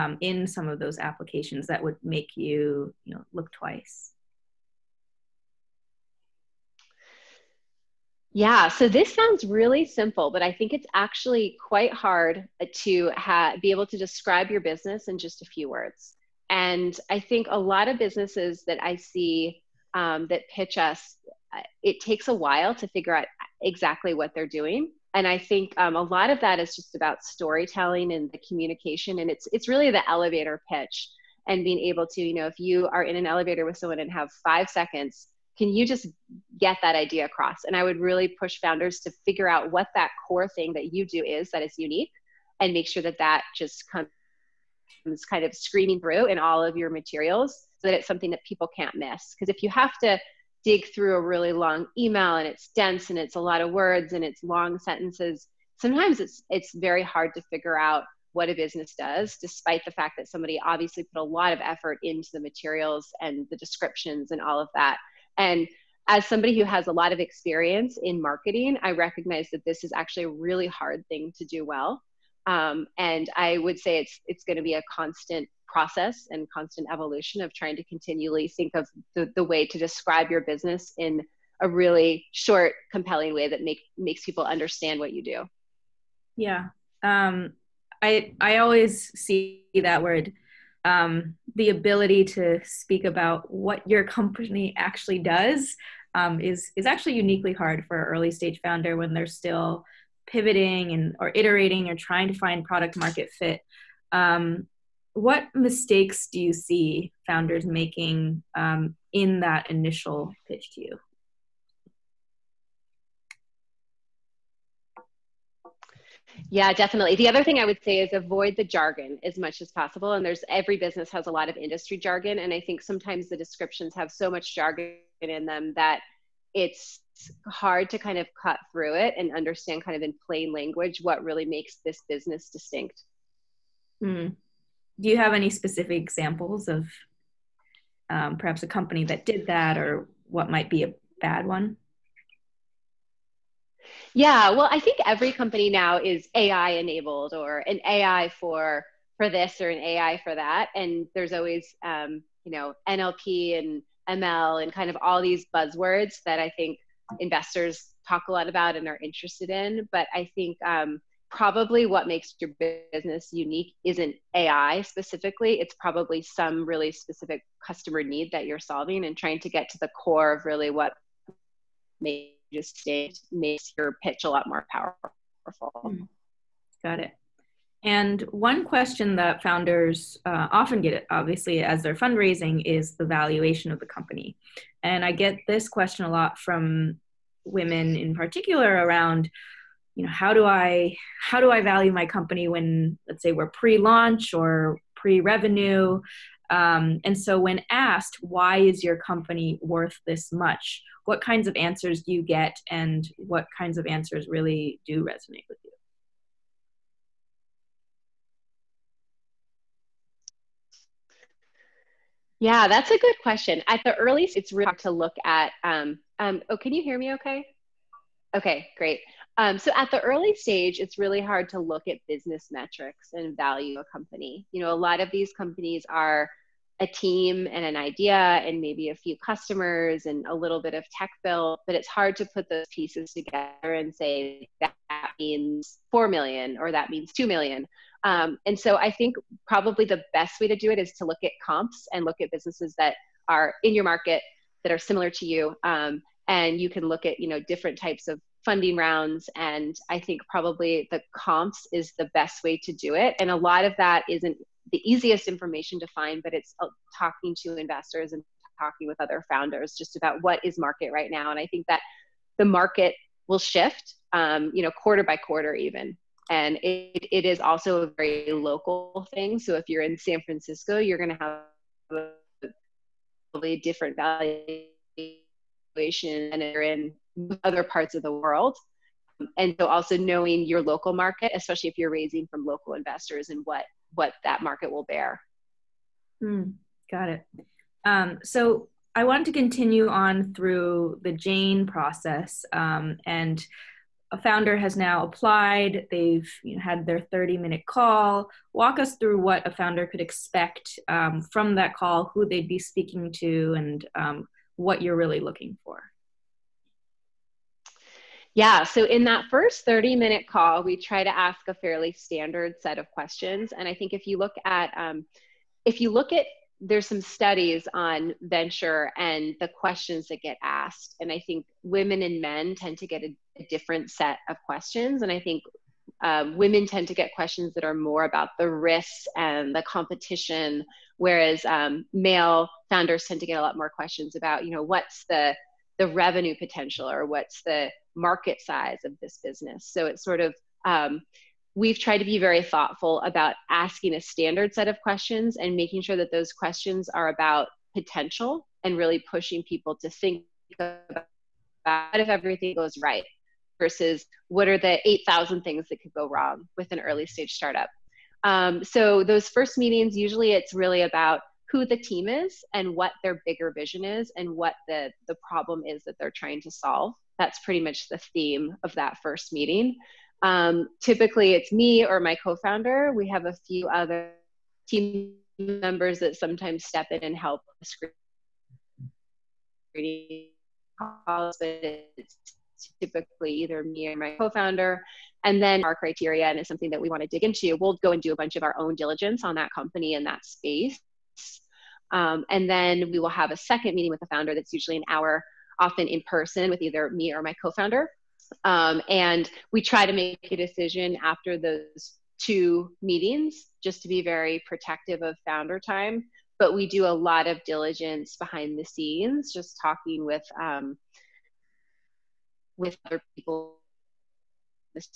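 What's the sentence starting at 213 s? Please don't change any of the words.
At the earliest, it's really hard to look at.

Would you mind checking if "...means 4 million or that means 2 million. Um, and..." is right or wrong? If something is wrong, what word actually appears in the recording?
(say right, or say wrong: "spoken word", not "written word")
right.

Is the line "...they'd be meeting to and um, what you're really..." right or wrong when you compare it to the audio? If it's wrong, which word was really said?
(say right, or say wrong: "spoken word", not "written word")
wrong: "speaking", not "meeting".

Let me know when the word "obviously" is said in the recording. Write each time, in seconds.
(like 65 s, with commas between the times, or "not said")
60 s, 181 s.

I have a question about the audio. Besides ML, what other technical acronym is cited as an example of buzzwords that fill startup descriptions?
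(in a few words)
NLP.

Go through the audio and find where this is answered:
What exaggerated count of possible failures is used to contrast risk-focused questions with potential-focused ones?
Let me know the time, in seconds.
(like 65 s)
354 s.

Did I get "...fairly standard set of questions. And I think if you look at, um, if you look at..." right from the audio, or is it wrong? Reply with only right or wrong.
right.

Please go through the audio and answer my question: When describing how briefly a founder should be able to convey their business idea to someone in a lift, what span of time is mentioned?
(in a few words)
5 seconds.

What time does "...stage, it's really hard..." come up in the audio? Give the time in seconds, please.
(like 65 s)
220 s.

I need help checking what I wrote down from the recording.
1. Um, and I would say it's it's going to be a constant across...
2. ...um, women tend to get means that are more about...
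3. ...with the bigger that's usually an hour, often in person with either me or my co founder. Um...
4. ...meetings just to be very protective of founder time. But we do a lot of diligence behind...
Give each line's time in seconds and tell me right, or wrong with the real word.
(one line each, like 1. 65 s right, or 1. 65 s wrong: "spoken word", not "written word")
1. 72 s wrong: "process", not "across"
2. 326 s wrong: "questions", not "means"
3. 393 s wrong: "founder", not "bigger"
4. 402 s right.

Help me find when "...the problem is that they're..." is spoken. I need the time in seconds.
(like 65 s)
365 s.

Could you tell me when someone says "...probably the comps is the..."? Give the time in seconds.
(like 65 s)
250 s.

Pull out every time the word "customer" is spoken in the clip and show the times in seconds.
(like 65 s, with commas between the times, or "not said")
167 s, 229 s.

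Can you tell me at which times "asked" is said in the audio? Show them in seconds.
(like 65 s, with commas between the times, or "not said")
197 s, 320 s.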